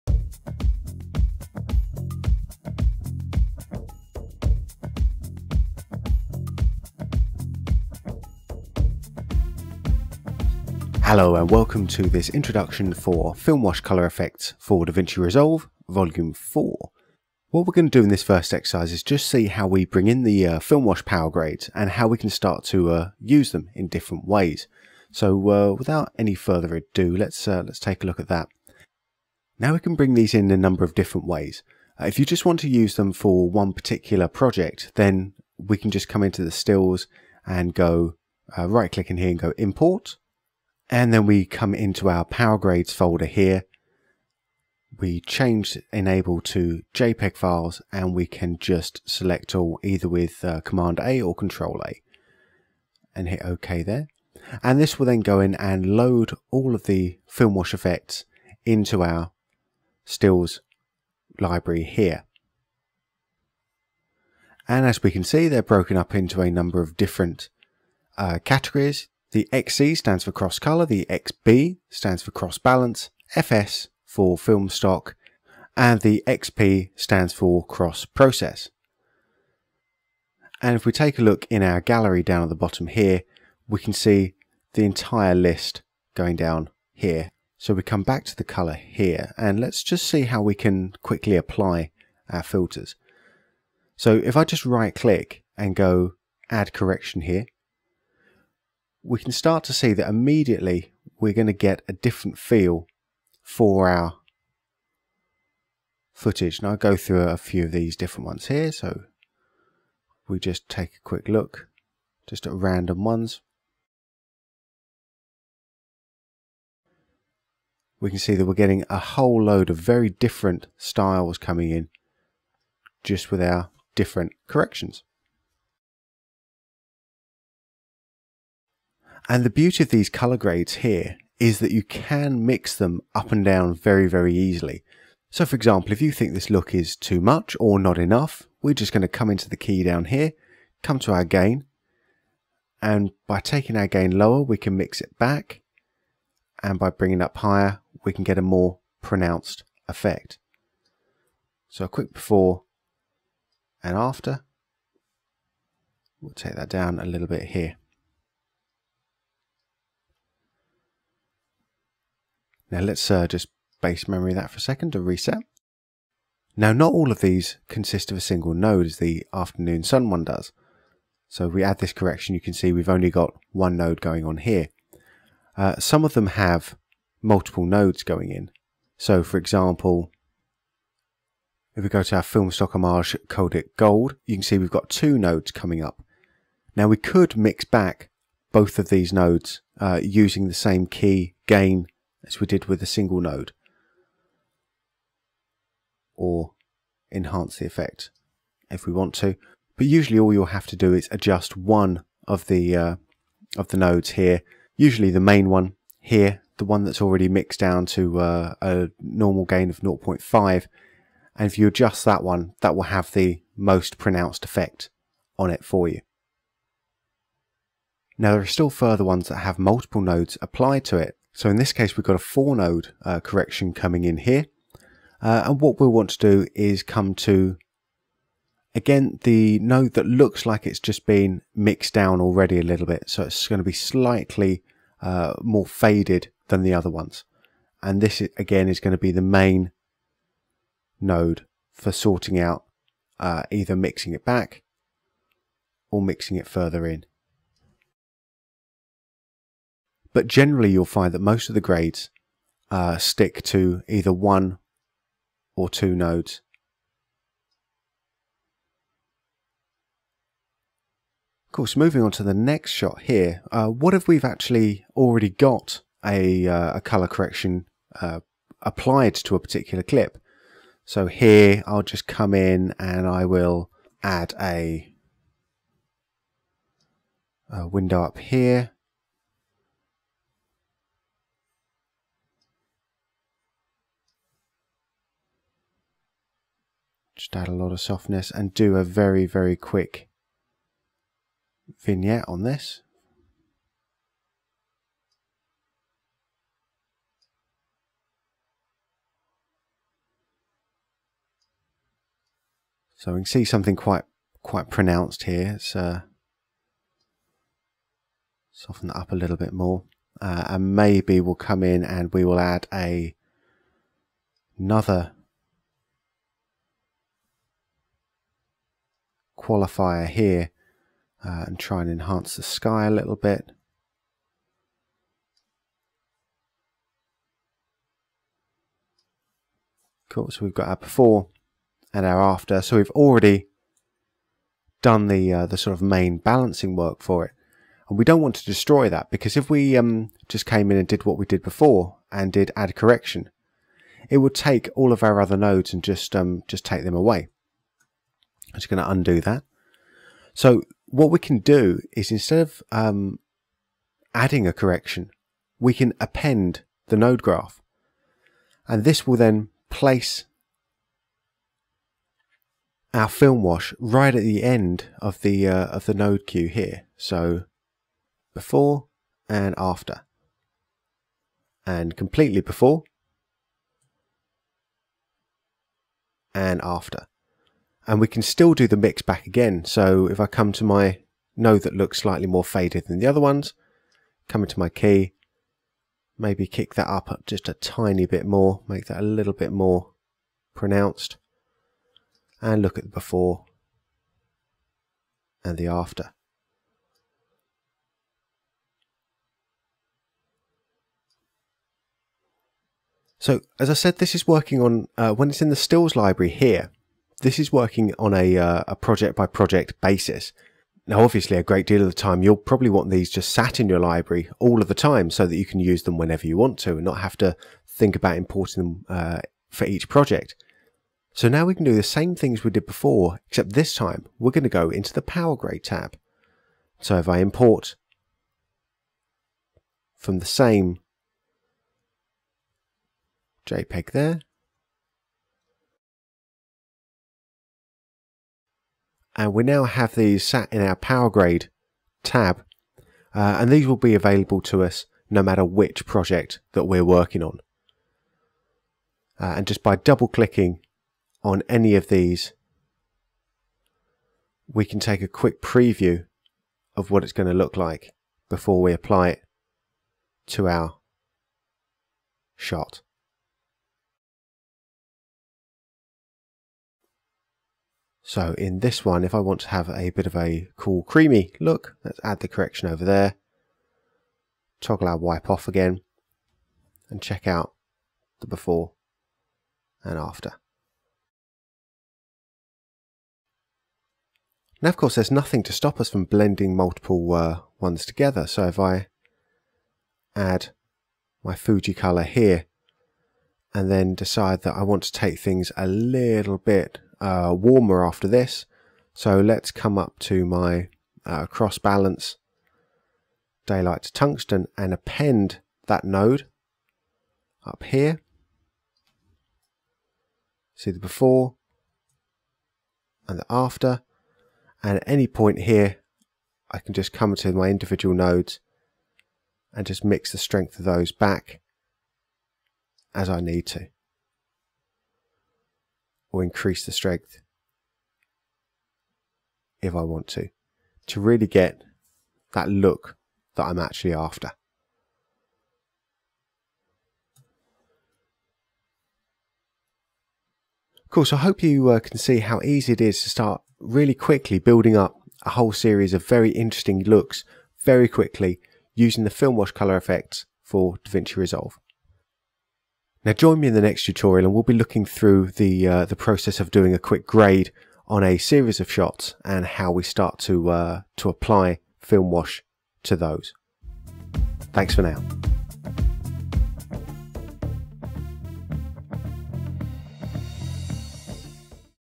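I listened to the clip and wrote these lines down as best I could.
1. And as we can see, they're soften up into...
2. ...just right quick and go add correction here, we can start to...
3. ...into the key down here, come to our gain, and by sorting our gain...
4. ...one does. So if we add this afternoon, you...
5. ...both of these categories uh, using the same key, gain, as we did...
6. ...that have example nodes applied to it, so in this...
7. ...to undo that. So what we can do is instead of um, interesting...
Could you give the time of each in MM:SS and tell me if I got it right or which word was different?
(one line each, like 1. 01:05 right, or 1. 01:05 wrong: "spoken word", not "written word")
1. 01:04 wrong: "broken", not "soften"
2. 01:34 wrong: "click", not "quick"
3. 02:19 wrong: "taking", not "sorting"
4. 02:50 wrong: "correction", not "afternoon"
5. 03:08 wrong: "nodes", not "categories"
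6. 03:39 wrong: "multiple", not "example"
7. 05:48 wrong: "adding", not "interesting".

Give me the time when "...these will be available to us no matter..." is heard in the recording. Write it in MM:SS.
07:23.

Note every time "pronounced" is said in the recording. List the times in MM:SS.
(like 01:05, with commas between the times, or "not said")
02:29, 03:33, 05:04, 06:30.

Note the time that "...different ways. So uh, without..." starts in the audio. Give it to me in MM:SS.
00:23.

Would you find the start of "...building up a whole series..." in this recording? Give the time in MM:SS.
09:04.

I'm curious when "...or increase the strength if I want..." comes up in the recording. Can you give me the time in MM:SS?
08:46.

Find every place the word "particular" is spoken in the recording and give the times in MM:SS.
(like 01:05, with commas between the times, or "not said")
00:33, 04:29.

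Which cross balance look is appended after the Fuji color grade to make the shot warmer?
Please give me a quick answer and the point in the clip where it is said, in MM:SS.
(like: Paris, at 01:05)
daylight to tungsten, at 08:23.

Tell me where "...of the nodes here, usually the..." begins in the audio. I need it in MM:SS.
03:23.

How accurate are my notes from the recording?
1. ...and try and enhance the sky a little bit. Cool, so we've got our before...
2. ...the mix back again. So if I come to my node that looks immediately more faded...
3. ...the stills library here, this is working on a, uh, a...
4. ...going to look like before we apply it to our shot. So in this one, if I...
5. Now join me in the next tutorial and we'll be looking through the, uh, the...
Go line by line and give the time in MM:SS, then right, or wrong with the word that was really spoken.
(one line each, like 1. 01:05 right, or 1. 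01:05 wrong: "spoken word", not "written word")
1. 05:21 right
2. 06:18 wrong: "slightly", not "immediately"
3. 06:45 right
4. 07:37 right
5. 09:13 right.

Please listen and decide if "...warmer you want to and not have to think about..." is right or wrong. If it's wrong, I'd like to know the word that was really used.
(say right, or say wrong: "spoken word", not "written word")
wrong: "whenever", not "warmer".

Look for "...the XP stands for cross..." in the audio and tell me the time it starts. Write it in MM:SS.
01:16.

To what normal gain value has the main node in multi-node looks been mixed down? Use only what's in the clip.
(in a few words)
0.5.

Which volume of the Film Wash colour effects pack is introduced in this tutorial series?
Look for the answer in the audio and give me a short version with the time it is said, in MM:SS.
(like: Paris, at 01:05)
4, at 00:15.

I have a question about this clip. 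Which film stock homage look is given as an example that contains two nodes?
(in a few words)
Kodak Gold.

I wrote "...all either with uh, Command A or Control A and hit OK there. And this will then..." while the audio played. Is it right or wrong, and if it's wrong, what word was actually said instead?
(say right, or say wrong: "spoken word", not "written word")
right.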